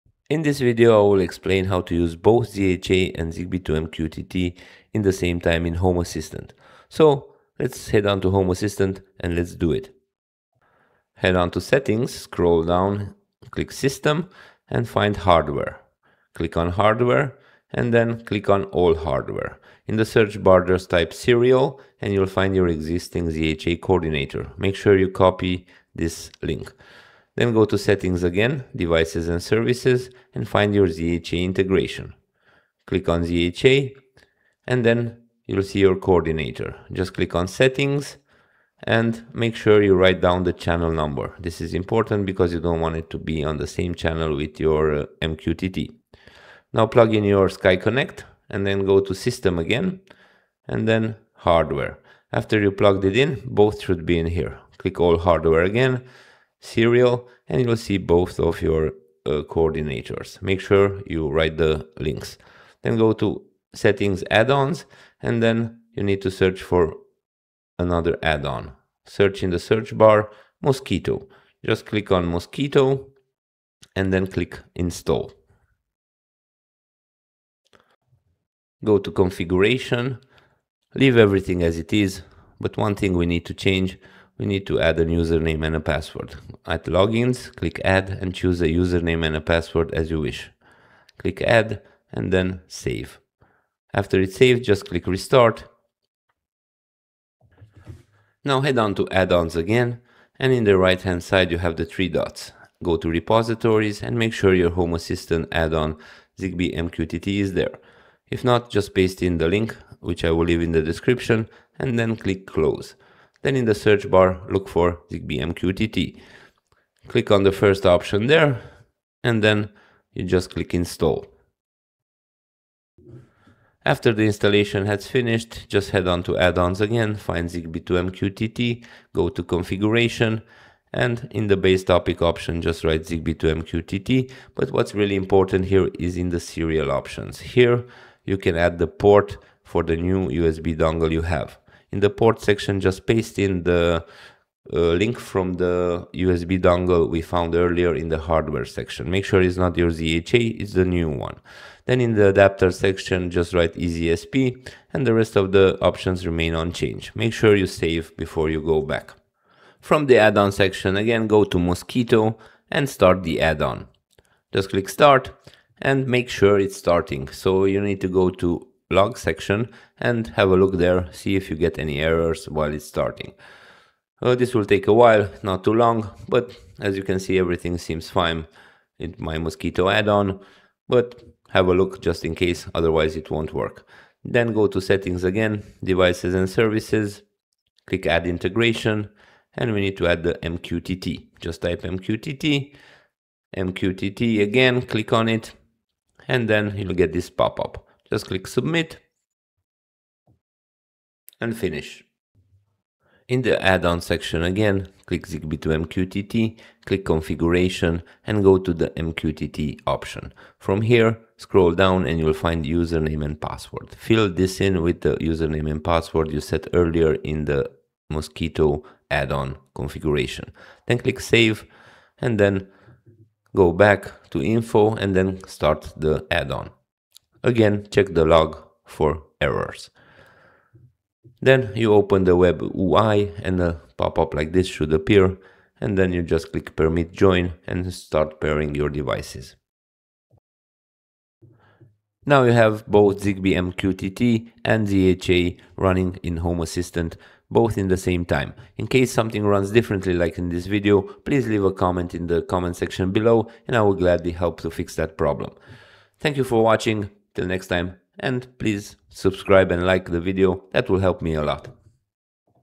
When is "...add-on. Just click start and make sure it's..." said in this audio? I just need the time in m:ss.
2:43.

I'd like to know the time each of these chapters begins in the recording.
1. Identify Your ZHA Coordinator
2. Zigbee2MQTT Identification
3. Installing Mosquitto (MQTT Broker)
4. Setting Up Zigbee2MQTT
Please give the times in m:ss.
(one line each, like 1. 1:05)
1. 0:10
2. 0:48
3. 1:03
4. 1:56.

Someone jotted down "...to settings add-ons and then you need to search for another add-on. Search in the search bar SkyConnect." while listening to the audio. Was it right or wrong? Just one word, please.
wrong.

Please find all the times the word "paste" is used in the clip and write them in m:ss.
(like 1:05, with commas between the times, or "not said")
1:48, 2:23.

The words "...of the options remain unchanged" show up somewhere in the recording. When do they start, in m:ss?
2:35.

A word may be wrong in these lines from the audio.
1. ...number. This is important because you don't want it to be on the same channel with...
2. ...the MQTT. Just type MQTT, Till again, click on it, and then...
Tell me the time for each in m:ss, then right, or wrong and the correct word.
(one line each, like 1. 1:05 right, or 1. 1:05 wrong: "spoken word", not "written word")
1. 0:40 right
2. 3:10 wrong: "MQTT", not "Till".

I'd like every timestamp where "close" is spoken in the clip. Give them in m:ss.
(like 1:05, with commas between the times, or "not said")
1:52.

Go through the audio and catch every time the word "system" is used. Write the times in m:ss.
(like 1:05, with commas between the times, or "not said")
0:13, 0:49.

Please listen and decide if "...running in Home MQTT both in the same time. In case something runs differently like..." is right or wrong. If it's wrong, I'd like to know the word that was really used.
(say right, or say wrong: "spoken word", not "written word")
wrong: "Assistant", not "MQTT".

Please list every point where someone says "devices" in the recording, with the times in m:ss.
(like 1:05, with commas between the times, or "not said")
0:28, 3:05, 3:58.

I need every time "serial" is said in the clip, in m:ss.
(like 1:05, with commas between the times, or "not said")
0:21, 0:56, 2:16.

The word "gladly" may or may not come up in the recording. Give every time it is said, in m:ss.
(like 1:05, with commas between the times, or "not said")
4:13.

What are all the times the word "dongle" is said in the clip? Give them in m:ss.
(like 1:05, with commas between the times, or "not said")
2:20, 2:26.